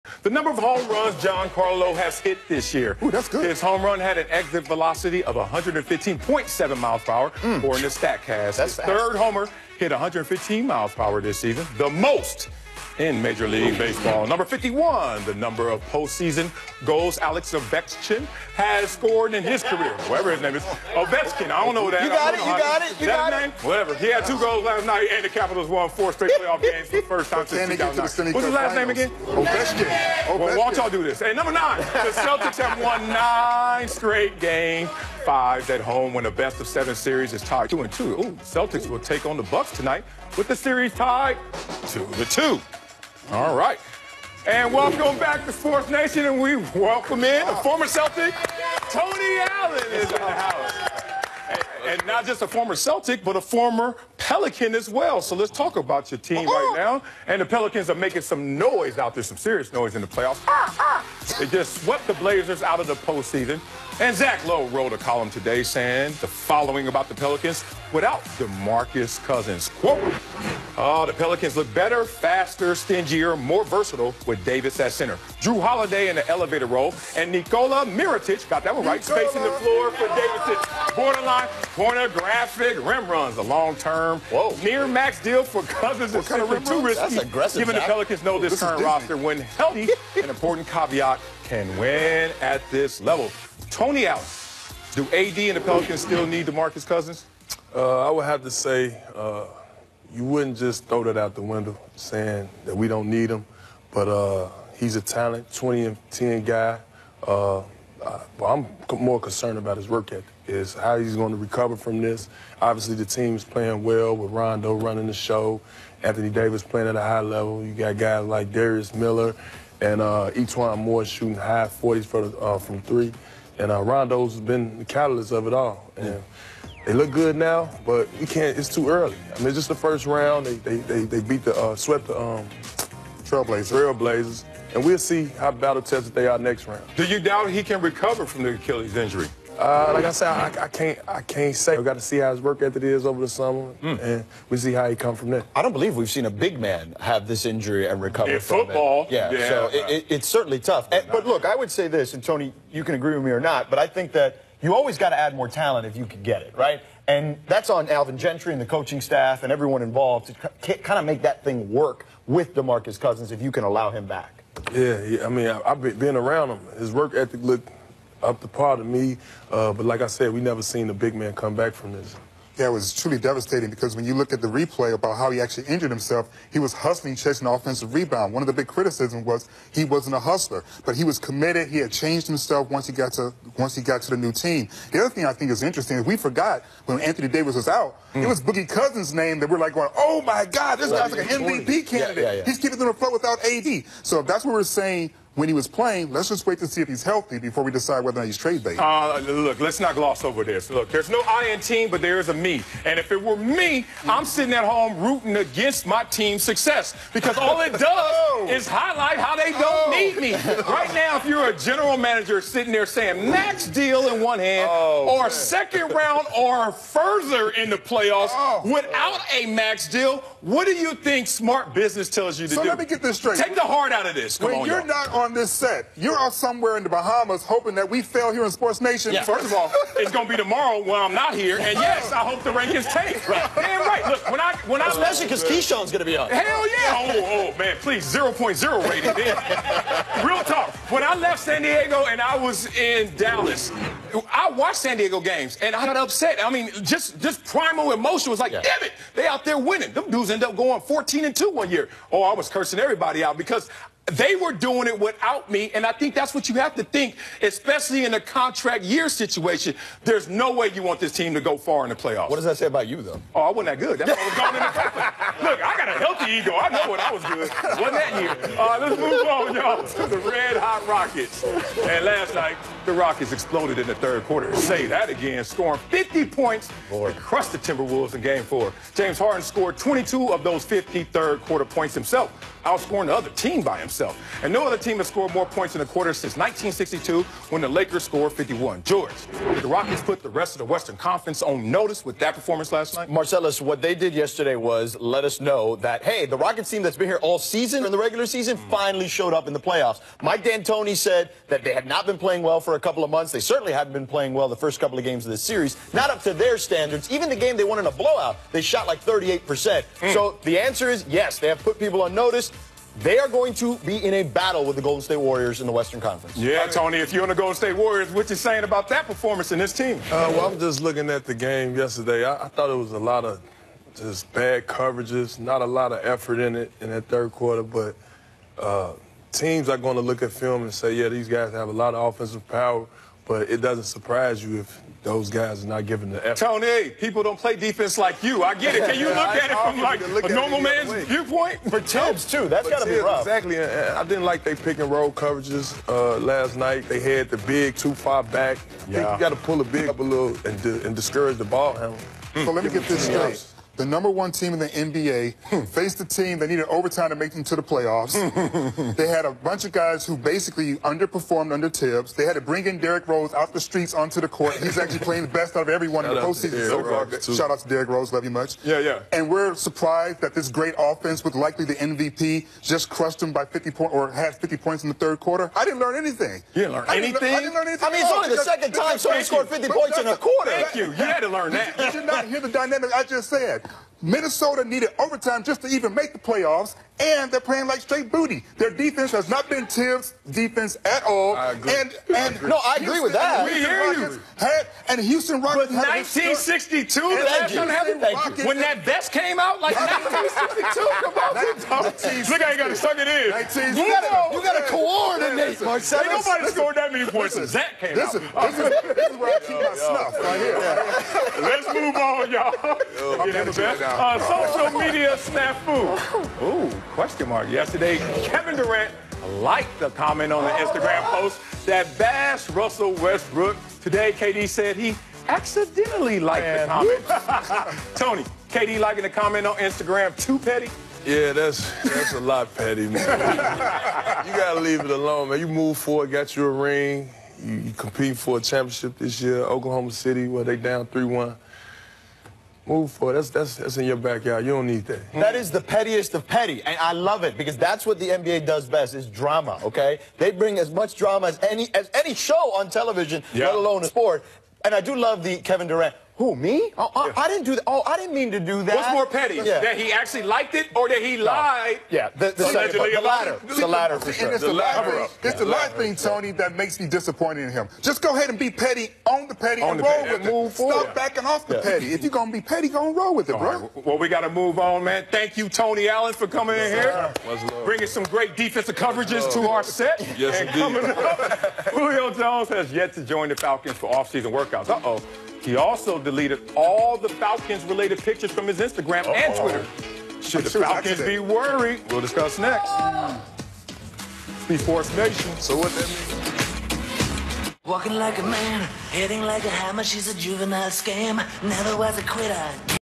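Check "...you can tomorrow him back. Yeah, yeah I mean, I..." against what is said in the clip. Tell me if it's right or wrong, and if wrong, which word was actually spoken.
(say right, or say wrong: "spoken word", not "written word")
wrong: "allow", not "tomorrow".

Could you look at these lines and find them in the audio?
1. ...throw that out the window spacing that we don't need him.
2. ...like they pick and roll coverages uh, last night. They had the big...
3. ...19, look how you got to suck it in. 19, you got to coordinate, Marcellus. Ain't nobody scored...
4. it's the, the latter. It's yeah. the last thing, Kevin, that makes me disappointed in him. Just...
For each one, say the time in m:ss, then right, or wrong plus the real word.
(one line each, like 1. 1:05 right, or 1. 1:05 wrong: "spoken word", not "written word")
1. 1:40 wrong: "saying", not "spacing"
2. 5:44 right
3. 6:42 right
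4. 7:44 wrong: "Tony", not "Kevin".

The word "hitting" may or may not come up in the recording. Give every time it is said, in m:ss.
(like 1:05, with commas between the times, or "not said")
8:18.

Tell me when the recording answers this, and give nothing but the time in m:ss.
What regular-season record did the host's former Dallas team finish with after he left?
4:10.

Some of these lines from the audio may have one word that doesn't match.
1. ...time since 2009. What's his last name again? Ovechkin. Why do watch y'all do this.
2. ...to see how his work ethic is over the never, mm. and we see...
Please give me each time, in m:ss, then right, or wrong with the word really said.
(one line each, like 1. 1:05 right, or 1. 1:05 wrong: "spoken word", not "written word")
1. 0:27 right
2. 2:21 wrong: "summer", not "never".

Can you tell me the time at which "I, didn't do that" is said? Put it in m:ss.
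7:37.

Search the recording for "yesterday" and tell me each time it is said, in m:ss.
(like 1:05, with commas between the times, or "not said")
4:54, 5:21, 6:57.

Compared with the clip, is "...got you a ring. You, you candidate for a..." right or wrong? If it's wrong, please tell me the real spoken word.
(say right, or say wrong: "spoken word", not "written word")
wrong: "compete", not "candidate".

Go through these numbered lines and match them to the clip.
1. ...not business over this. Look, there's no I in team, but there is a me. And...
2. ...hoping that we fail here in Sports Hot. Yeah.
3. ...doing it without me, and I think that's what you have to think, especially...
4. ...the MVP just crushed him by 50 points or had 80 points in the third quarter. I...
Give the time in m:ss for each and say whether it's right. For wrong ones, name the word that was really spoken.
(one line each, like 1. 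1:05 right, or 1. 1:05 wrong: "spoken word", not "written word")
1. 3:19 wrong: "gloss", not "business"
2. 3:47 wrong: "Nation", not "Hot"
3. 4:14 right
4. 6:11 wrong: "50", not "80".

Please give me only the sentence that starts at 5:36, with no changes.
Tony, people don't play defense like you.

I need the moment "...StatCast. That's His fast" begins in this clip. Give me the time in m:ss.
0:07.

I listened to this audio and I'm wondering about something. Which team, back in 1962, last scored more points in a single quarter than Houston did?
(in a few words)
Lakers.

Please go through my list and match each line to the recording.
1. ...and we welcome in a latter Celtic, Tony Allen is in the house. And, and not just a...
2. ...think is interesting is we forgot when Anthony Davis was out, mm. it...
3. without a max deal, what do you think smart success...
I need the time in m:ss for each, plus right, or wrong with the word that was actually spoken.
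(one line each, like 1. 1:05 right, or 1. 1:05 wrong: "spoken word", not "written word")
1. 0:46 wrong: "former", not "latter"
2. 3:05 right
3. 3:38 wrong: "business", not "success".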